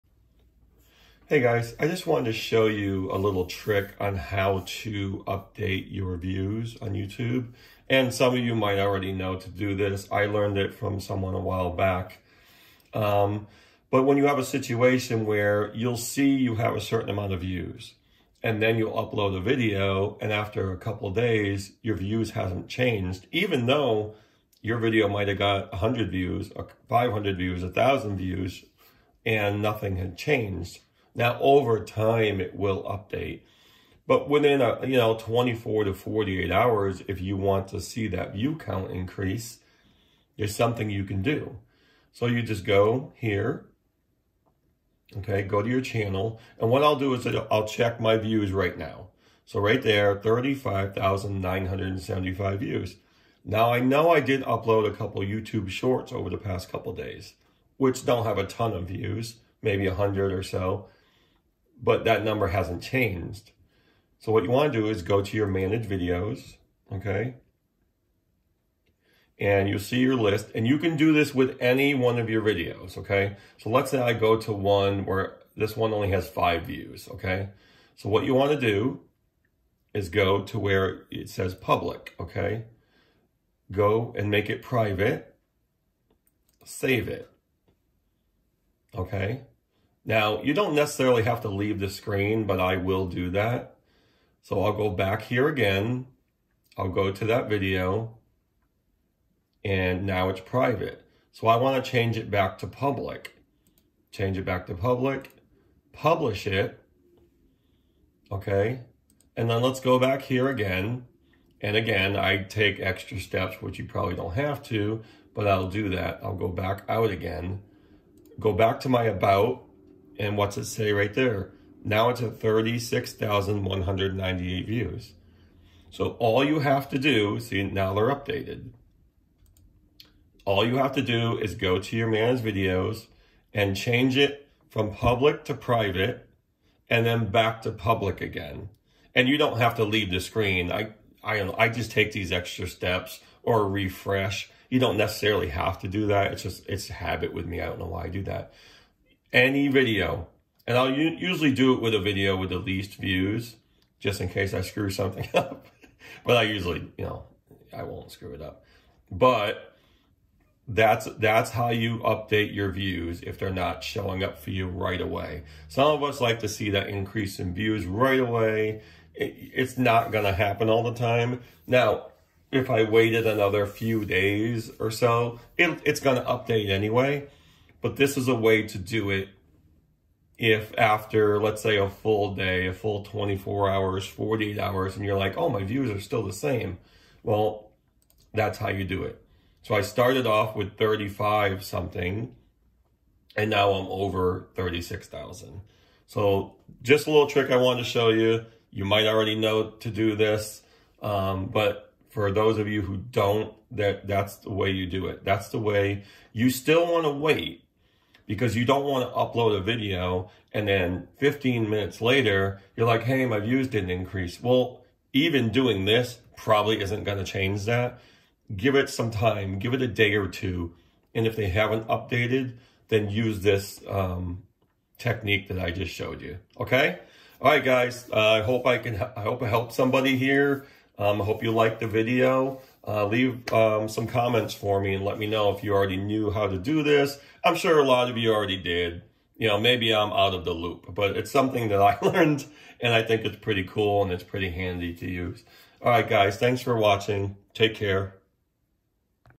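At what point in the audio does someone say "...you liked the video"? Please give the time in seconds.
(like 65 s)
231 s.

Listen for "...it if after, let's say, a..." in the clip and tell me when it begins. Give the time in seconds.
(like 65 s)
179 s.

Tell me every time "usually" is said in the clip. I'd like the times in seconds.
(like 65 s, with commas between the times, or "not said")
150 s, 156 s.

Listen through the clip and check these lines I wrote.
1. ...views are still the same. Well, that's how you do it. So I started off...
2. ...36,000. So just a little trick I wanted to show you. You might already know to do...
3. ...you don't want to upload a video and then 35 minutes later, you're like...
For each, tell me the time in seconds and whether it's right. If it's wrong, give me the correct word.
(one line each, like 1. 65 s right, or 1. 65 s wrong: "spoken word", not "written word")
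1. 185 s right
2. 194 s right
3. 208 s wrong: "15", not "35".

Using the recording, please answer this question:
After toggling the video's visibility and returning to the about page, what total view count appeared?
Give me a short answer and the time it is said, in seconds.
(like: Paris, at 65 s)
36,198, at 122 s.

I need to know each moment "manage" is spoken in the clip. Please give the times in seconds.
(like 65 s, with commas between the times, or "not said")
65 s, 132 s.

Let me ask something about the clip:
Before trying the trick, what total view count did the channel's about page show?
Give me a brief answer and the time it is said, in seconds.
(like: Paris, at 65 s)
35,975, at 50 s.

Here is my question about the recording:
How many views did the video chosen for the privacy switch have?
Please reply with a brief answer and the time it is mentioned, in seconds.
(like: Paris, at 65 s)
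5, at 76 s.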